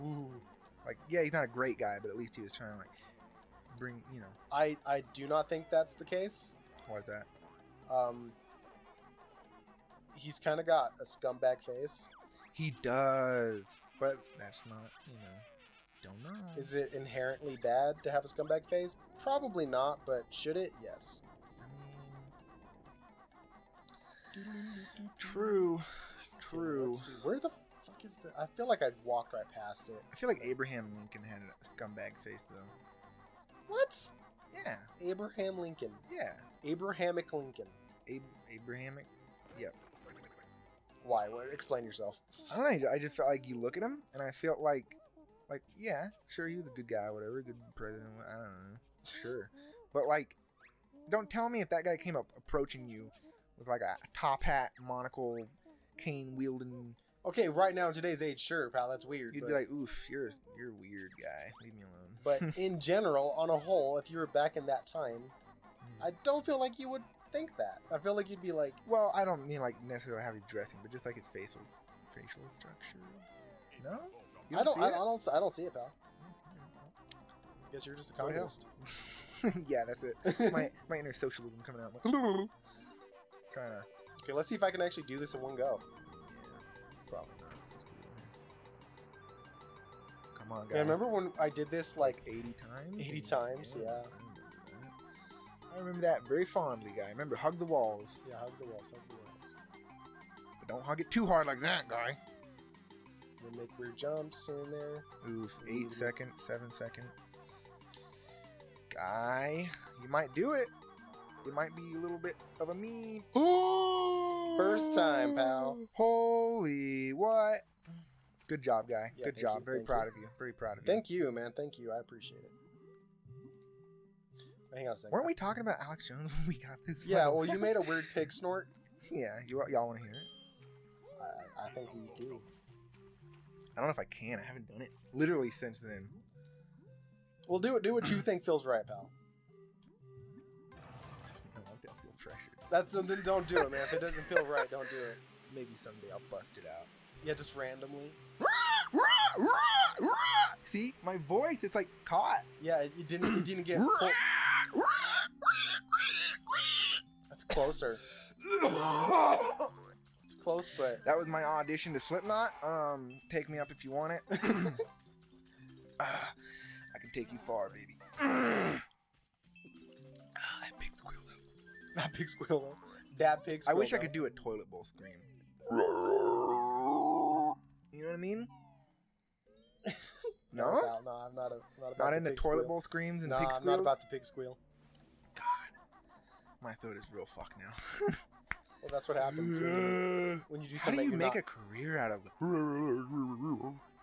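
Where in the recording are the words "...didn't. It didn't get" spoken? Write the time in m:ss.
2:33.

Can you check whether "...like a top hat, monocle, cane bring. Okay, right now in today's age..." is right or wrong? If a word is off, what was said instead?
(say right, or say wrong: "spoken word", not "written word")
wrong: "wielding", not "bring".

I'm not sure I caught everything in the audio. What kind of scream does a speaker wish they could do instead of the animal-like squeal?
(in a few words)
toilet bowl scream.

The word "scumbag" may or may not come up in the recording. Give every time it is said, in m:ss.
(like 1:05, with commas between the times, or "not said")
0:11, 0:18, 0:31.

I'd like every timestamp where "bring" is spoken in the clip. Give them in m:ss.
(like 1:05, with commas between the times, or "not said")
0:03.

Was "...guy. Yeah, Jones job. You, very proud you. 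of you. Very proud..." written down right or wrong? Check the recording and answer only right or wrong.
wrong.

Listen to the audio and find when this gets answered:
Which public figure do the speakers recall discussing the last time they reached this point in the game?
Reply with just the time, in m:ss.
2:05.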